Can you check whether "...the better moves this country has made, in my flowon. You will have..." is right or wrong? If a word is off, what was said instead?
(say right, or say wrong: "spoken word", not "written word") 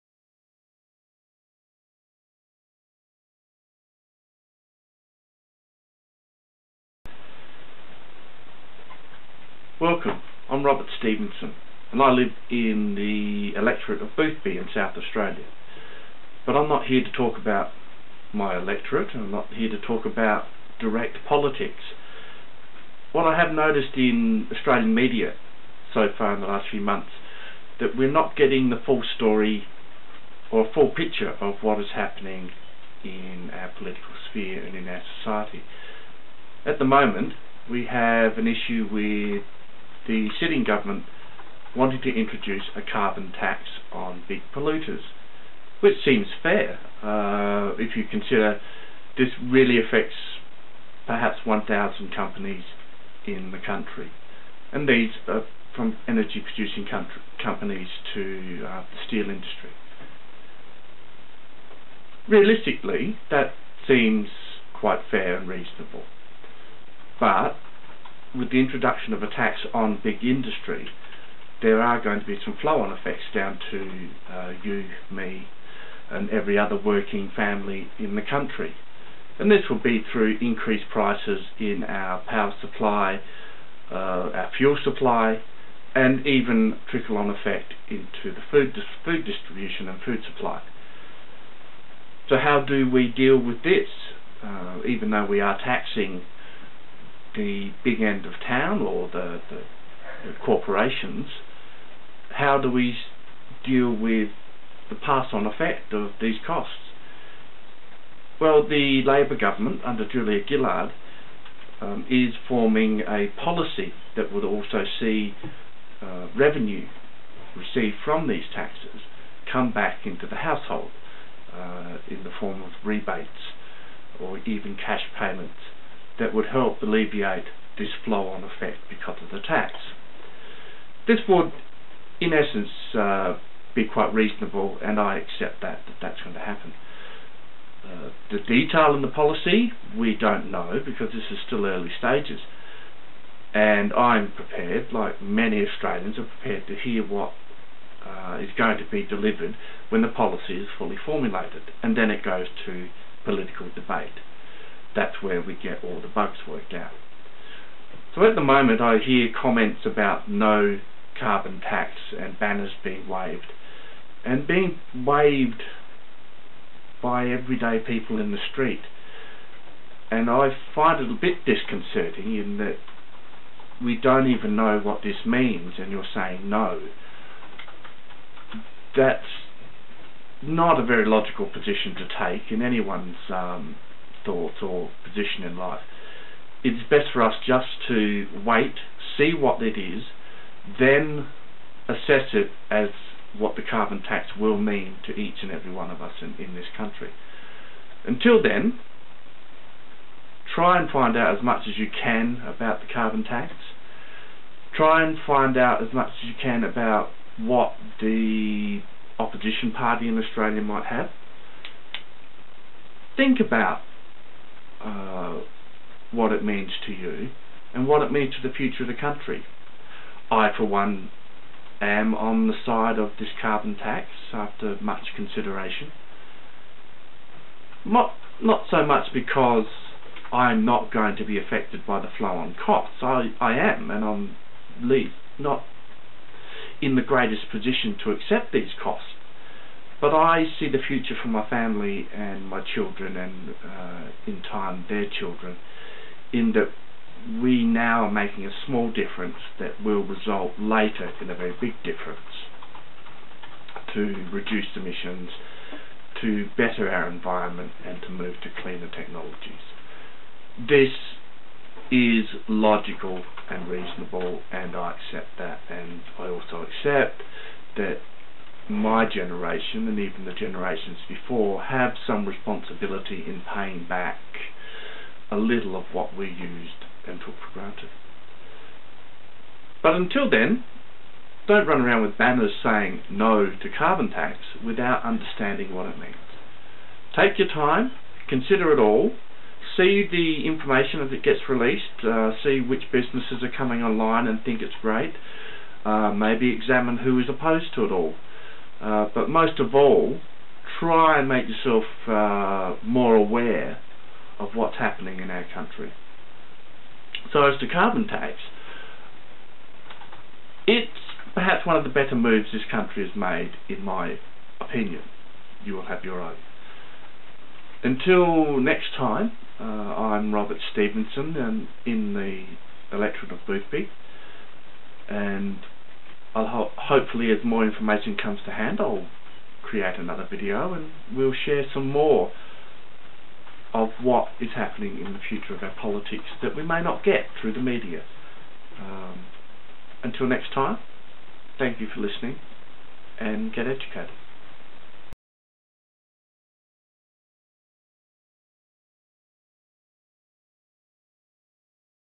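wrong: "opinion", not "flowon".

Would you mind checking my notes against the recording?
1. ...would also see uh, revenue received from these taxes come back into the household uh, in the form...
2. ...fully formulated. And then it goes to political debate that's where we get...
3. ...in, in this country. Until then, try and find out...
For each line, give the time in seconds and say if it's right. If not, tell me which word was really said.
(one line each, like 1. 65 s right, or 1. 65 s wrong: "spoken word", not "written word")
1. 114 s right
2. 150 s right
3. 196 s right.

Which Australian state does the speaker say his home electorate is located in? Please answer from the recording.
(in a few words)
South Australia.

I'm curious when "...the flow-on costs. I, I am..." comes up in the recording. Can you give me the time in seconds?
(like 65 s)
232 s.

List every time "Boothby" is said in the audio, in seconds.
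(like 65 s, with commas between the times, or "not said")
14 s, 323 s.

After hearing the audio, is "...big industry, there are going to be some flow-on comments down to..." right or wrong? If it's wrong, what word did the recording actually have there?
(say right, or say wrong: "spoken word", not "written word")
wrong: "effects", not "comments".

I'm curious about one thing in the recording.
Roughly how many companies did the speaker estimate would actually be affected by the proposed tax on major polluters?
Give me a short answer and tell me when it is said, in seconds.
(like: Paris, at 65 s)
1,000, at 51 s.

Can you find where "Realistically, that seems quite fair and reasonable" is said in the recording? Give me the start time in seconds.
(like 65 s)
62 s.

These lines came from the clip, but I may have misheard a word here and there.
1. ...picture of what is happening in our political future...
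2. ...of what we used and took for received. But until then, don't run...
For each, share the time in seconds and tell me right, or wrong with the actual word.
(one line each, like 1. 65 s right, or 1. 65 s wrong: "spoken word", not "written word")
1. 30 s wrong: "sphere", not "future"
2. 275 s wrong: "granted", not "received".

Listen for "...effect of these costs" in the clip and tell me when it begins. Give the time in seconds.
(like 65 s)
105 s.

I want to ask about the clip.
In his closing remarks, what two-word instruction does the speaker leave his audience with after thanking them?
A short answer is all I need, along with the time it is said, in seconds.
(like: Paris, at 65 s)
get educated, at 343 s.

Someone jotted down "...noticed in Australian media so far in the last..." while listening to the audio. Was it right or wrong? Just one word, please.
right.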